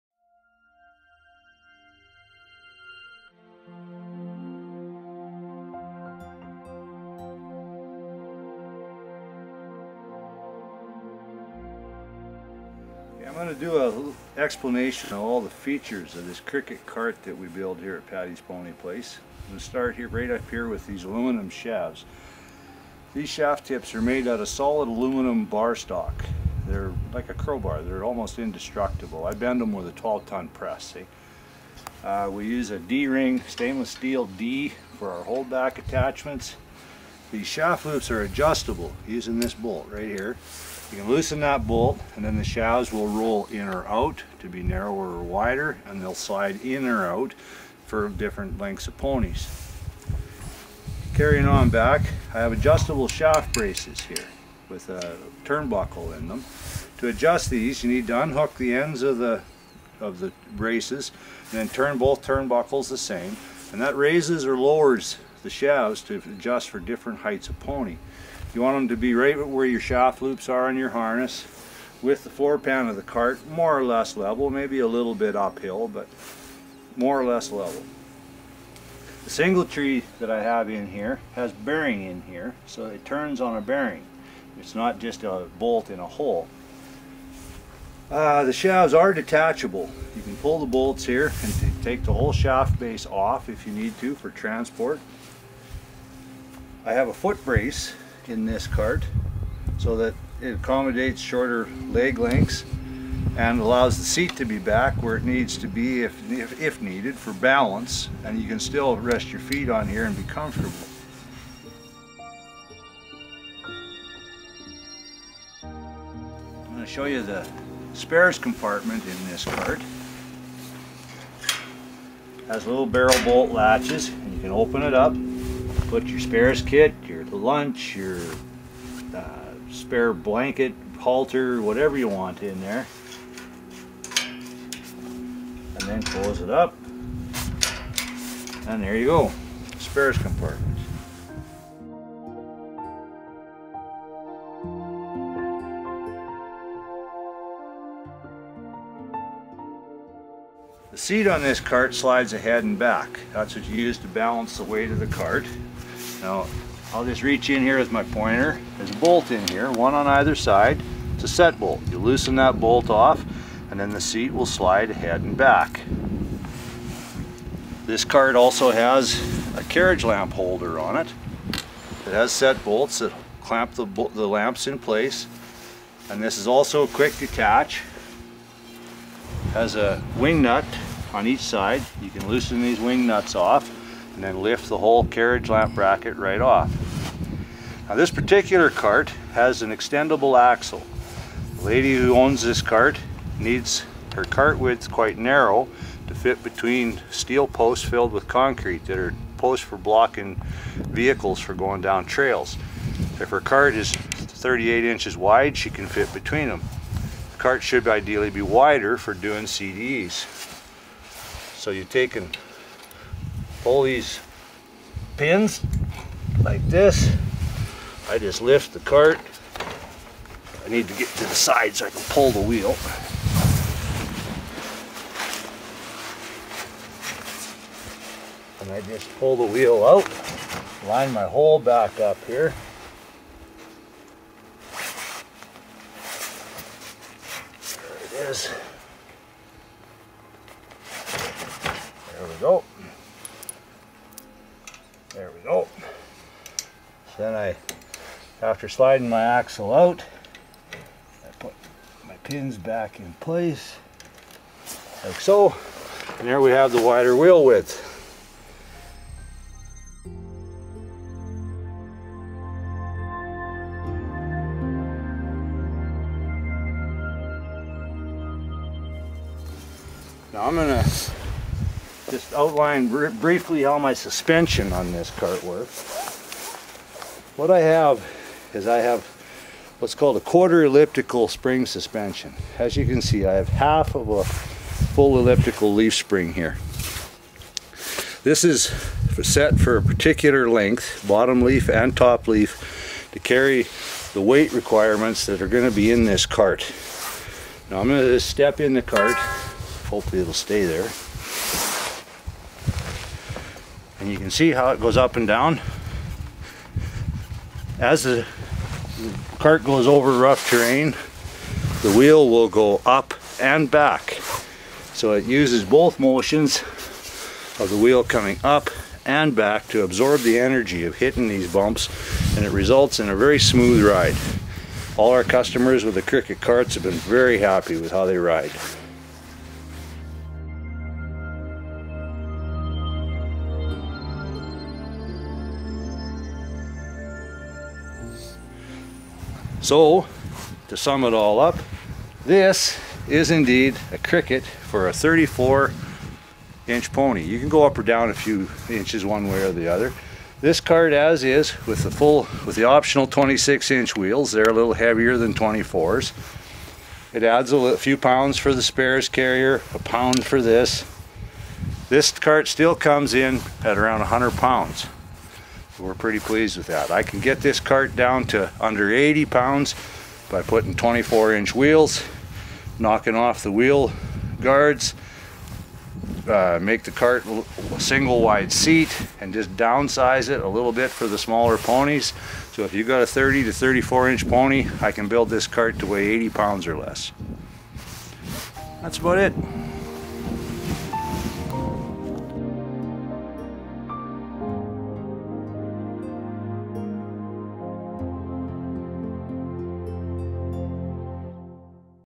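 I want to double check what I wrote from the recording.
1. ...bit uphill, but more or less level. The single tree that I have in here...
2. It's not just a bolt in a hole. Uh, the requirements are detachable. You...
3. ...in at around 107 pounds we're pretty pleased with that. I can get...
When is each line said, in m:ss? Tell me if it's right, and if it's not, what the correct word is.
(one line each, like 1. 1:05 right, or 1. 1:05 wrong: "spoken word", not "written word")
1. 1:15 right
2. 1:24 wrong: "shafts", not "requirements"
3. 6:03 wrong: "100", not "107".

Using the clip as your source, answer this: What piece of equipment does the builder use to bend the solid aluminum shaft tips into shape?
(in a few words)
12-ton press.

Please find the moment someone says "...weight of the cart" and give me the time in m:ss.
2:34.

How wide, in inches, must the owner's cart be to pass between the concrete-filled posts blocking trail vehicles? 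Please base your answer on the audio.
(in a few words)
38 inches.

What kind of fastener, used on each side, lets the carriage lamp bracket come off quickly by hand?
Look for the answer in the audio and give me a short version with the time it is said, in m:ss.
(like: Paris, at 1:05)
wing nut, at 3:00.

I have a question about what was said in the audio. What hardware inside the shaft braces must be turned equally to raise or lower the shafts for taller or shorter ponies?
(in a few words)
turnbuckle.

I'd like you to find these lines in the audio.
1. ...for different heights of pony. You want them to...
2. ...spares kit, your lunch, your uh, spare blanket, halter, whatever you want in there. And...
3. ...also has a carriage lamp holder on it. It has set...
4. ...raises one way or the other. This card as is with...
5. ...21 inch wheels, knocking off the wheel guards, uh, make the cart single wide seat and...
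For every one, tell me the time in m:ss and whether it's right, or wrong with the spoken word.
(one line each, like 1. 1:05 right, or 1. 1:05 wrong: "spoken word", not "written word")
1. 1:06 right
2. 2:06 right
3. 2:48 right
4. 5:48 wrong: "inches", not "raises"
5. 6:10 wrong: "24", not "21".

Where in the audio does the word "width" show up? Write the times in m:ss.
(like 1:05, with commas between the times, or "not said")
3:14, 4:17.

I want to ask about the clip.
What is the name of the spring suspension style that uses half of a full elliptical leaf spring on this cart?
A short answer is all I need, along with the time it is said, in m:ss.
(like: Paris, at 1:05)
quarter elliptical spring, at 4:40.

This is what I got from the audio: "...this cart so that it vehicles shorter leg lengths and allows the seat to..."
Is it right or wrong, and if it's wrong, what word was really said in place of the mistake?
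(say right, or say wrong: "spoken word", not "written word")
wrong: "accommodates", not "vehicles".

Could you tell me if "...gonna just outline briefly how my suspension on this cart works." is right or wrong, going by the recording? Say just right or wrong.
right.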